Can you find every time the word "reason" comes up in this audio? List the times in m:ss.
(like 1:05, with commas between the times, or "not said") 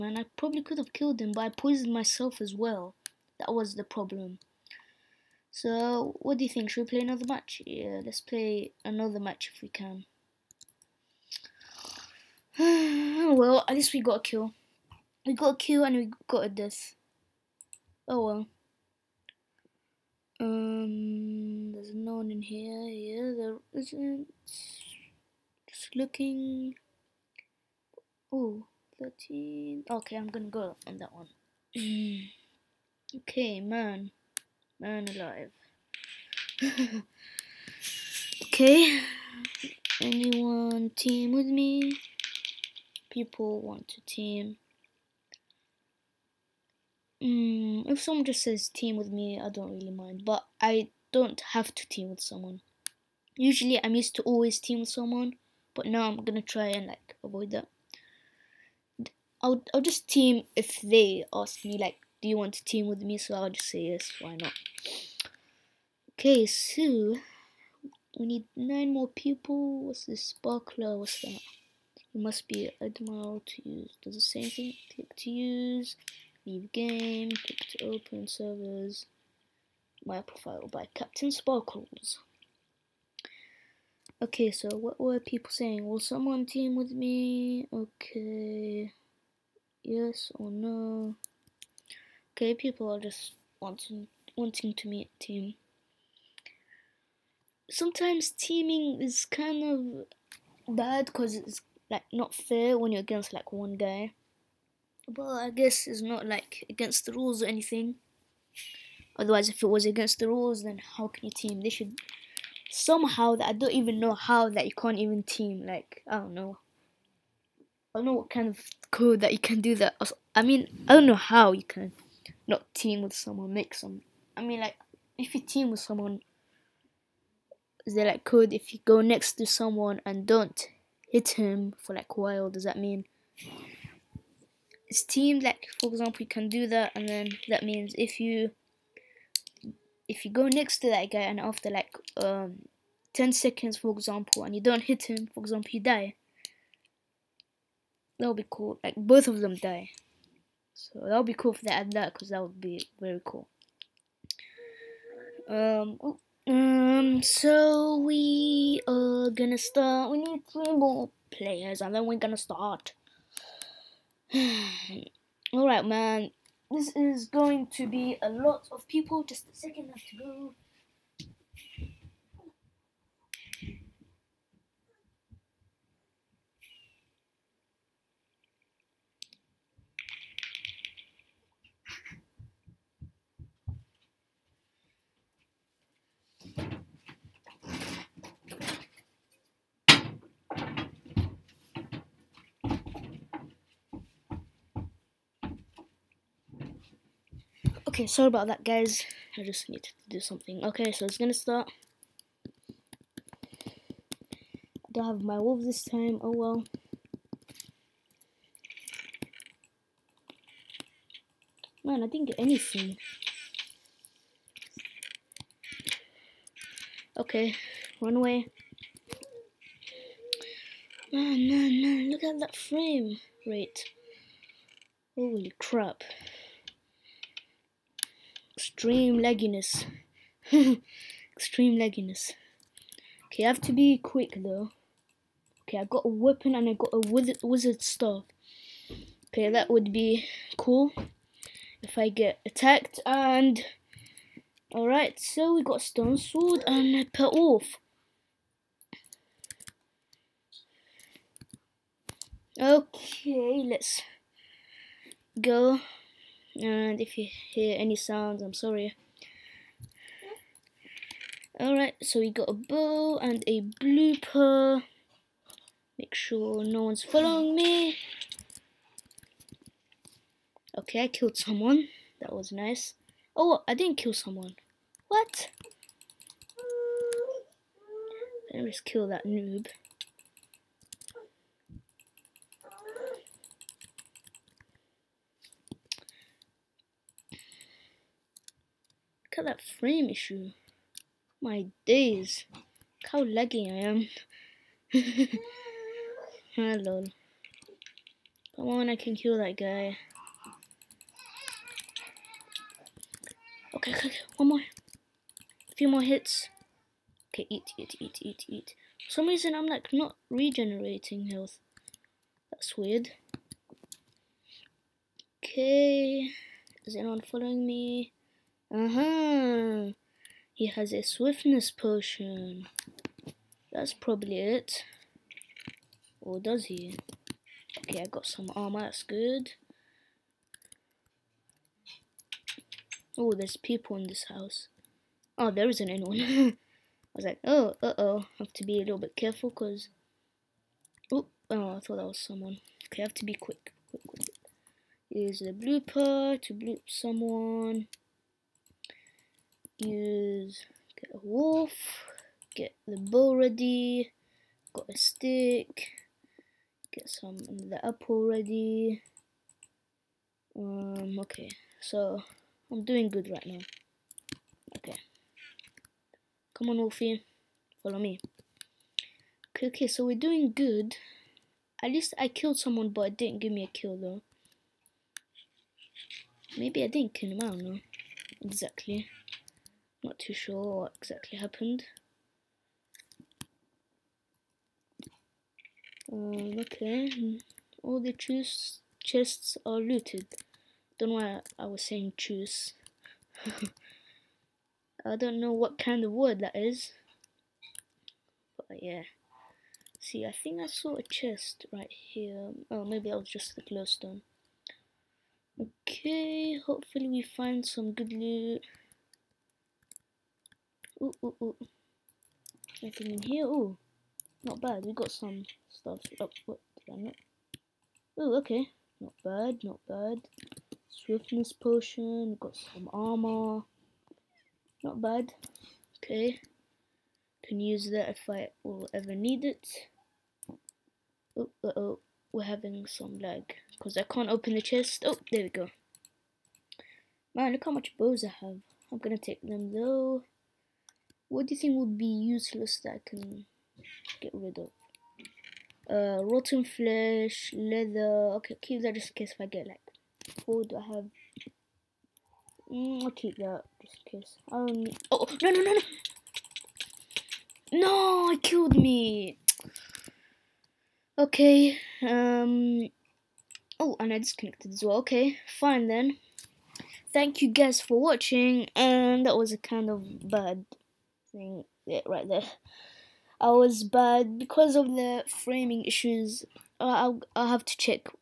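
5:09.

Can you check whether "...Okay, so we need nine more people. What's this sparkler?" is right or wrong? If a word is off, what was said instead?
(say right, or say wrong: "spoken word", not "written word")
right.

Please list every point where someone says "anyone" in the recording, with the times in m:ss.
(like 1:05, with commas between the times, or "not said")
0:40, 5:16, 5:35.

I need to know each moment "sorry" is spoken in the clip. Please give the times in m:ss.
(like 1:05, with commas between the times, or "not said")
3:18, 4:18.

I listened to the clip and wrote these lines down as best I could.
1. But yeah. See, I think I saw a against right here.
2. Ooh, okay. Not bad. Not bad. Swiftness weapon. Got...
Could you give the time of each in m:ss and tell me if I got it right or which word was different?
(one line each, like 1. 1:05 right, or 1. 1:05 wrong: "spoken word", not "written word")
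1. 6:38 wrong: "chest", not "against"
2. 6:58 wrong: "potion", not "weapon".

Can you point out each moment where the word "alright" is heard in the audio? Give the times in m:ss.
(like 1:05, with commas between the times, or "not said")
2:45, 4:04, 4:21.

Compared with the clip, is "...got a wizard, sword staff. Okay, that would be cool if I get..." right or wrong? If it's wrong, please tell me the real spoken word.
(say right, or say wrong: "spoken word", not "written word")
wrong: "wizard", not "sword".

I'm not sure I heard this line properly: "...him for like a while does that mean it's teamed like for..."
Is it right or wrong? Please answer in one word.
right.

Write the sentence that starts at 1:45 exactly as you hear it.
But I guess it's not like against the rules or anything.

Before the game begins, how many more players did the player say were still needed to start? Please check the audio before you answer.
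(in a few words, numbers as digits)
3.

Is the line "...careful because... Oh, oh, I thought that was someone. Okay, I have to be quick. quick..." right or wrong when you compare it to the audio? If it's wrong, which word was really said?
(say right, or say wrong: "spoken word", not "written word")
right.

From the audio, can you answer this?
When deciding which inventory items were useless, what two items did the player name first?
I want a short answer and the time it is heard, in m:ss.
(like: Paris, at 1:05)
rotten flesh, leather, at 7:26.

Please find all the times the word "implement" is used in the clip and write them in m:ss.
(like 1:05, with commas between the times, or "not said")
not said.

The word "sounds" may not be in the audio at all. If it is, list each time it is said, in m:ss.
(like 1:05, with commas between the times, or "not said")
4:17.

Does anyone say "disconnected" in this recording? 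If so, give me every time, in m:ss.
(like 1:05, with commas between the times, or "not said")
7:44.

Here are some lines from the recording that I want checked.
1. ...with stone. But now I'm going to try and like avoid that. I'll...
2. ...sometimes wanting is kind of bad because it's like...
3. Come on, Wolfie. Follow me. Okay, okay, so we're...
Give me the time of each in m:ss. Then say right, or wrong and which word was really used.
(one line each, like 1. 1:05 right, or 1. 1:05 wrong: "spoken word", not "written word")
1. 0:54 wrong: "someone", not "stone"
2. 1:37 wrong: "teaming", not "wanting"
3. 6:06 right.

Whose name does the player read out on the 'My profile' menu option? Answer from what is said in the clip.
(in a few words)
CaptainSparklez.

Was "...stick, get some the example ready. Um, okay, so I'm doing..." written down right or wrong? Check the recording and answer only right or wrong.
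wrong.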